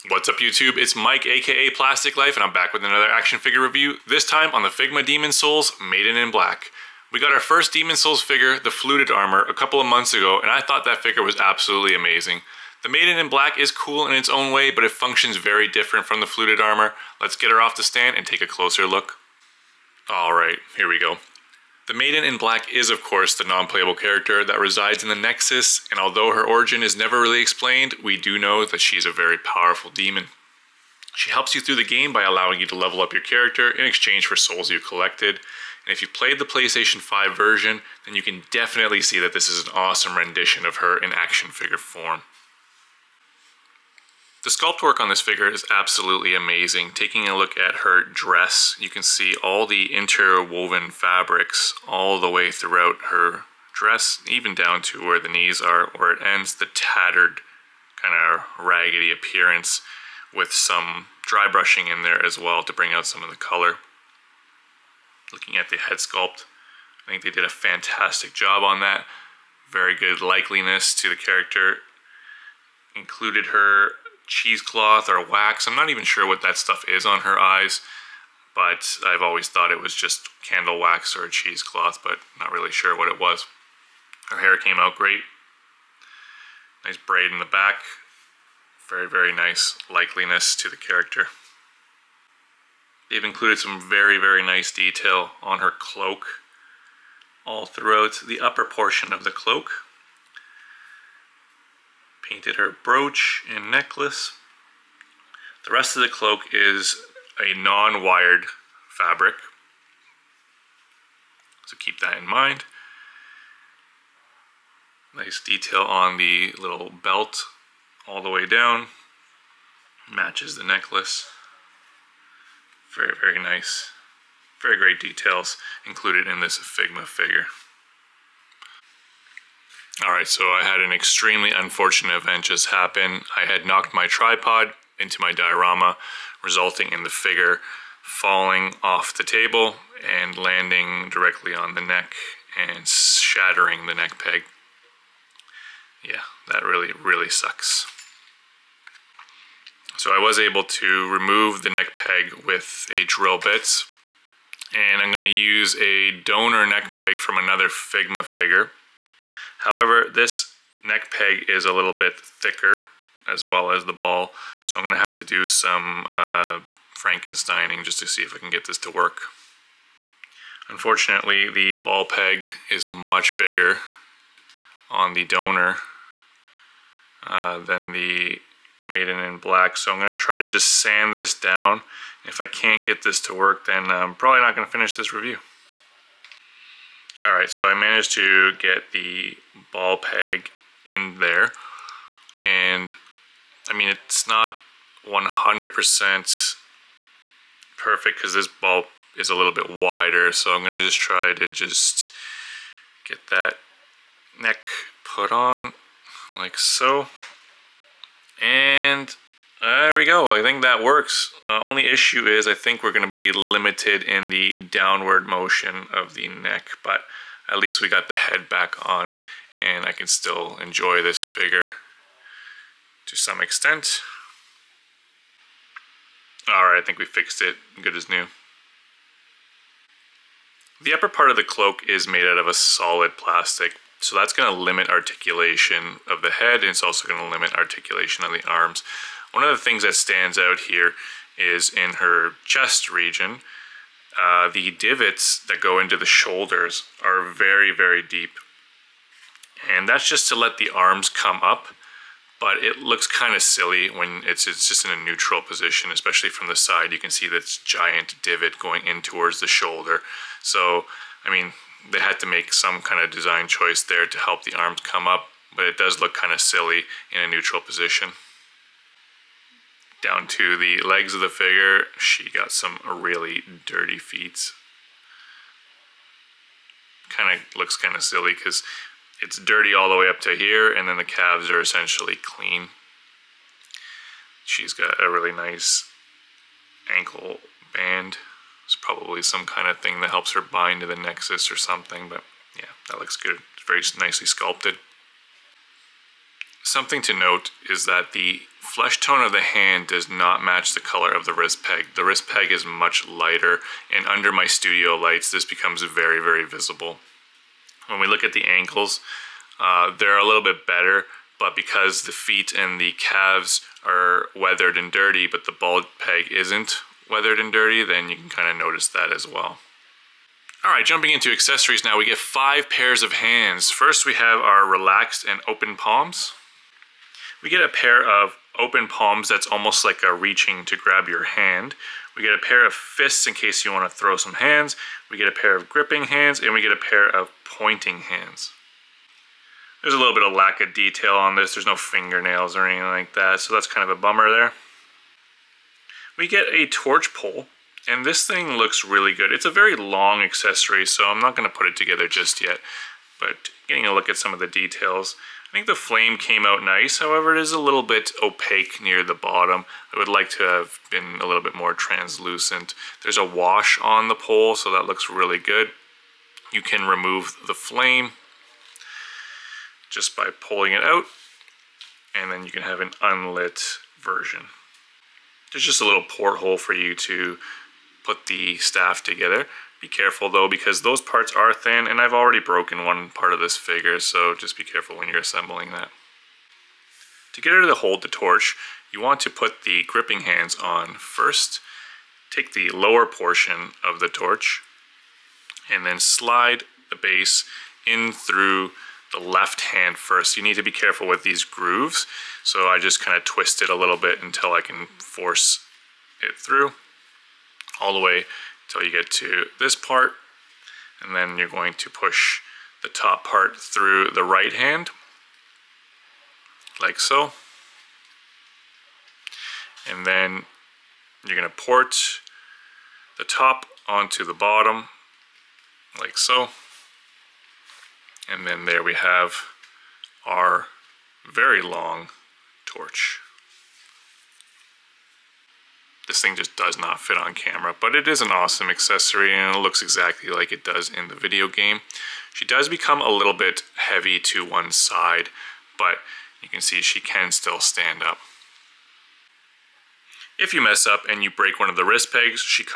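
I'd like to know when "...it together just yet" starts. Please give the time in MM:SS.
05:51.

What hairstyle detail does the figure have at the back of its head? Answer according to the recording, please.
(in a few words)
braid.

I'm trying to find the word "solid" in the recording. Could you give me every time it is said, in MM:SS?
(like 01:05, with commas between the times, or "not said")
03:52.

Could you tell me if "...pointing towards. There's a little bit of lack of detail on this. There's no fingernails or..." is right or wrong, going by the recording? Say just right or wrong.
wrong.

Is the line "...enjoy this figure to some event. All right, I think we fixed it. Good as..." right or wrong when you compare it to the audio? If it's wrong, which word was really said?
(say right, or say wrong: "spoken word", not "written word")
wrong: "extent", not "event".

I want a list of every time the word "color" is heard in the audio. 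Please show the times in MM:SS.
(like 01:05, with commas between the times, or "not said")
01:03, 05:00.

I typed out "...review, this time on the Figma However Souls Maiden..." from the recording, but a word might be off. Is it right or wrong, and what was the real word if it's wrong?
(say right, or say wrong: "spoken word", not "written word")
wrong: "Demon", not "However".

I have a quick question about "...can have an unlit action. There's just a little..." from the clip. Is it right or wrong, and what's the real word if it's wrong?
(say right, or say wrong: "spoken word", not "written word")
wrong: "version", not "action".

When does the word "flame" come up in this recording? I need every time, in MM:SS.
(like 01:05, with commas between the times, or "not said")
05:55, 06:07.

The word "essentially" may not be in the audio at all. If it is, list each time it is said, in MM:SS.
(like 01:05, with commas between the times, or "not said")
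04:41.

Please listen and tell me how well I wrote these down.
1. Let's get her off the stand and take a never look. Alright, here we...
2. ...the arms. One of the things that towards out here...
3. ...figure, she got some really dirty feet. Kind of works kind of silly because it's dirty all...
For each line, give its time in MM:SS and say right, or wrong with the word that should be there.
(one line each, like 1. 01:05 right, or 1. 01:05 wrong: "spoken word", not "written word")
1. 00:17 wrong: "closer", not "never"
2. 03:58 wrong: "stands", not "towards"
3. 04:31 wrong: "looks", not "works".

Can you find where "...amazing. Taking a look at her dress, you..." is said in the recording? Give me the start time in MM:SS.
00:46.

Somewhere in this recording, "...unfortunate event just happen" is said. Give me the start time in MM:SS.
02:11.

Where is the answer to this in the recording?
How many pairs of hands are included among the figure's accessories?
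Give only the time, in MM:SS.
05:22.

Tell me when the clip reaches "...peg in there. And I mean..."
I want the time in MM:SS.
03:09.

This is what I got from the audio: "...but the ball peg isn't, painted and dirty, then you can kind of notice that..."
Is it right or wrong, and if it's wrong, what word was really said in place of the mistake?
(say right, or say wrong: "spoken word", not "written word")
wrong: "weathered", not "painted".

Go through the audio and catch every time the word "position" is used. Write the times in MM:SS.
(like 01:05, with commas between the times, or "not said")
04:15, 04:27.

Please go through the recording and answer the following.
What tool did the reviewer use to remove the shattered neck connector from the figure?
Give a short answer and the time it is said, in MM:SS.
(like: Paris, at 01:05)
drill bit, at 02:33.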